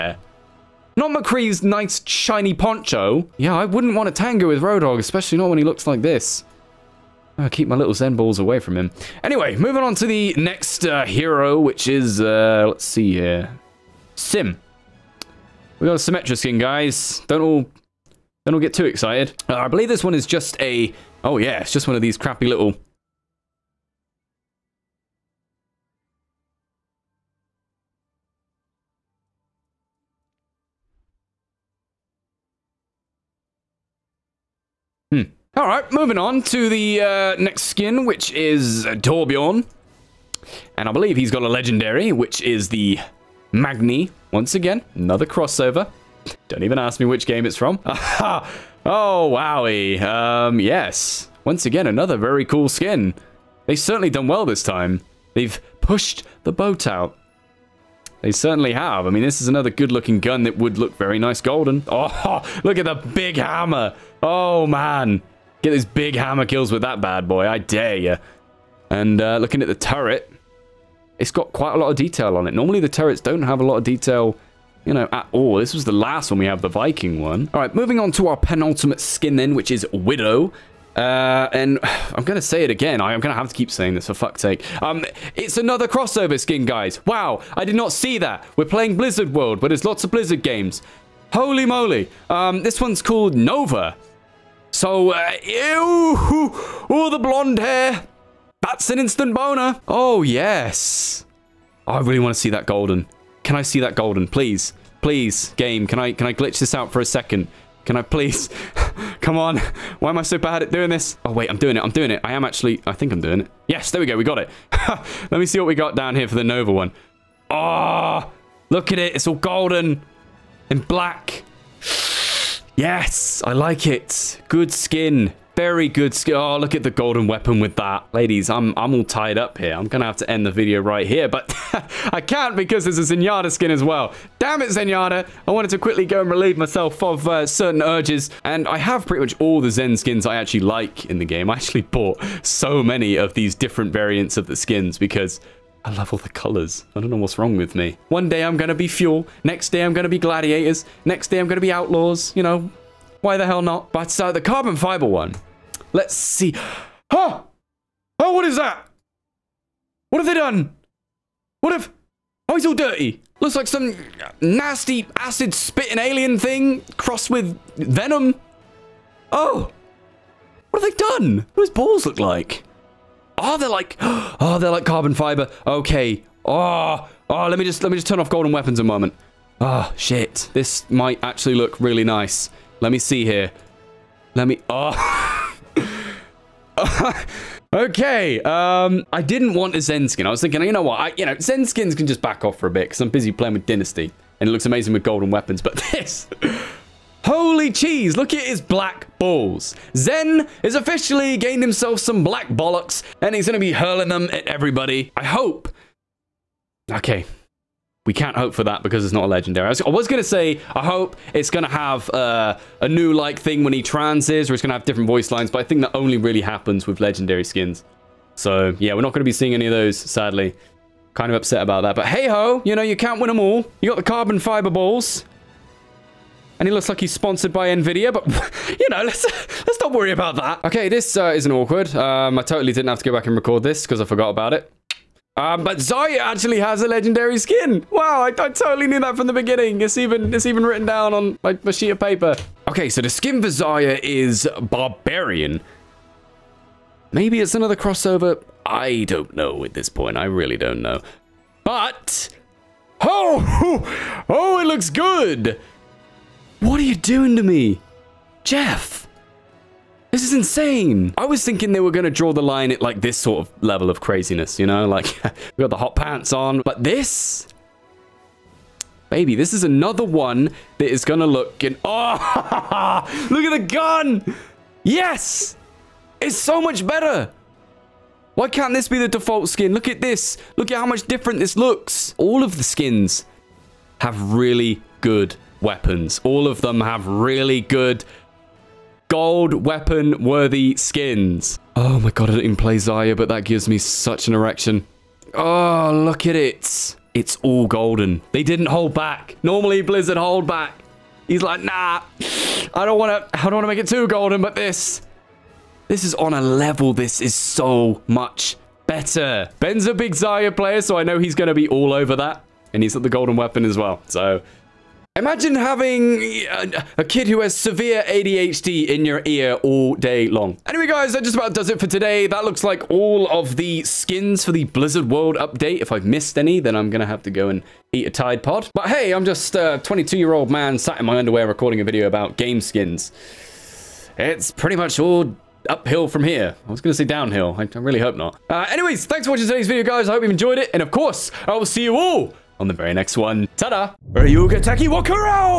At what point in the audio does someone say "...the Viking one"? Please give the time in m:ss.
1:16.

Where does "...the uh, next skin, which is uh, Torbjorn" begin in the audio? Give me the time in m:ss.
0:36.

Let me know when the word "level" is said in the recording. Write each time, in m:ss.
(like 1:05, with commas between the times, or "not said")
4:23, 5:06.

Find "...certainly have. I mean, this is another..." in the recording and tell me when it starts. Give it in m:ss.
0:58.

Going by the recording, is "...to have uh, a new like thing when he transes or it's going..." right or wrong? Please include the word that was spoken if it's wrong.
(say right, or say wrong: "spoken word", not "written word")
right.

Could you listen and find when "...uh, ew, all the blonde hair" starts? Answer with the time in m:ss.
1:35.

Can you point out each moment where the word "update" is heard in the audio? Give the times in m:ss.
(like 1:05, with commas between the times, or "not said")
5:25.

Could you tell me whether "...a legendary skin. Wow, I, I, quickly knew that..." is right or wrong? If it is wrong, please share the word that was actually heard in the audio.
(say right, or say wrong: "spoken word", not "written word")
wrong: "totally", not "quickly".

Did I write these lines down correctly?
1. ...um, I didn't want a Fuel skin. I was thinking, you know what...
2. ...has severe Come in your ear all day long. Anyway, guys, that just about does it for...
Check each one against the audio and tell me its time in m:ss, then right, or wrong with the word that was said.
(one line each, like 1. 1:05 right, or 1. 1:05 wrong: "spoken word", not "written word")
1. 3:08 wrong: "Zen", not "Fuel"
2. 5:17 wrong: "ADHD", not "Come".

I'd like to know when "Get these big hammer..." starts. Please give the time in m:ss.
1:05.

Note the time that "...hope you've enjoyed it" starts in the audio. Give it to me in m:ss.
5:40.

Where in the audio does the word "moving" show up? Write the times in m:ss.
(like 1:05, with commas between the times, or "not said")
0:09, 0:35, 1:17.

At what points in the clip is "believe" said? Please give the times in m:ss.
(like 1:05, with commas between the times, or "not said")
0:19, 0:40.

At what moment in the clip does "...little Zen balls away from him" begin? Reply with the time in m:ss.
0:07.